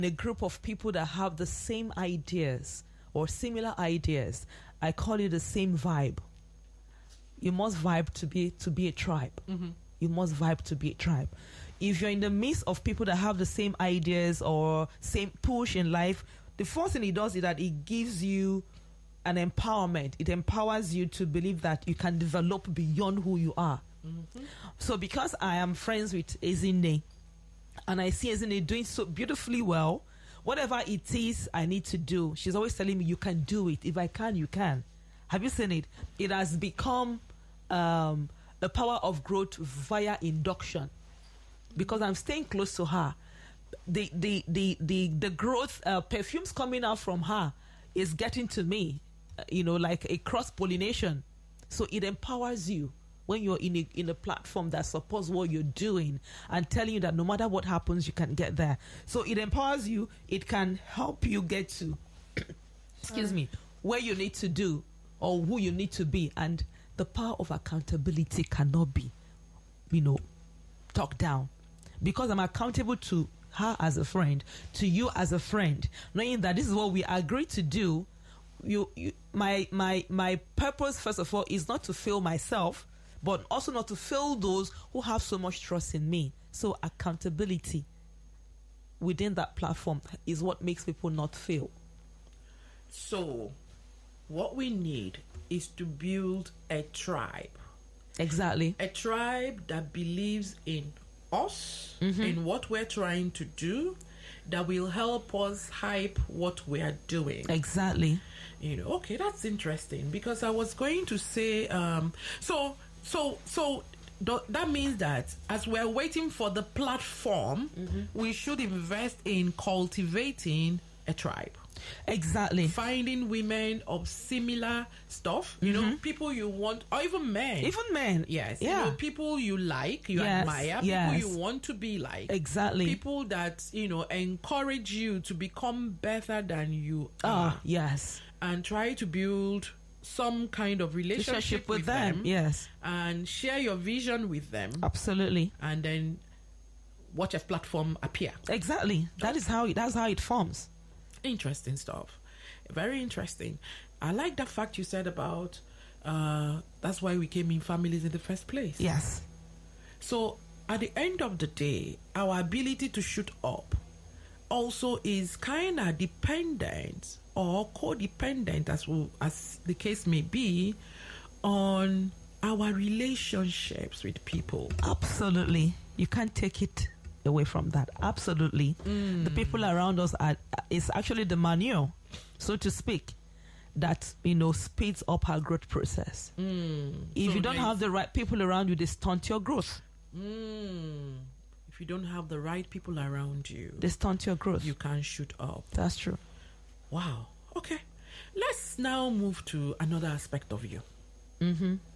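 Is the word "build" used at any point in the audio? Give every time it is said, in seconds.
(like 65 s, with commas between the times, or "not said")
95 s, 139 s.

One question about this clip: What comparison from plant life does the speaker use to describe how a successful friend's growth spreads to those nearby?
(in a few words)
cross pollination.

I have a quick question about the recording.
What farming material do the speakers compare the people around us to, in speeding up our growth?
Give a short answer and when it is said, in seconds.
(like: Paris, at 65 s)
manure, at 181 s.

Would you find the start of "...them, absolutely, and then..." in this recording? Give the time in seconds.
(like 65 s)
144 s.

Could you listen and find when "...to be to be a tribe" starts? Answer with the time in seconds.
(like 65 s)
8 s.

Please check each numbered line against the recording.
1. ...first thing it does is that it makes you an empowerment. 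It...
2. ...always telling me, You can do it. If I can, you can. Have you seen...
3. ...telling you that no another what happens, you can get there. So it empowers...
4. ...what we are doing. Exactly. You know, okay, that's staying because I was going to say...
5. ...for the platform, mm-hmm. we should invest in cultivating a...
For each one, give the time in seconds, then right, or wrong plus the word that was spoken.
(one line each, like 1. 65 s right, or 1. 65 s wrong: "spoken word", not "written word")
1. 16 s wrong: "gives", not "makes"
2. 32 s right
3. 56 s wrong: "matter", not "another"
4. 106 s wrong: "interesting", not "staying"
5. 116 s right.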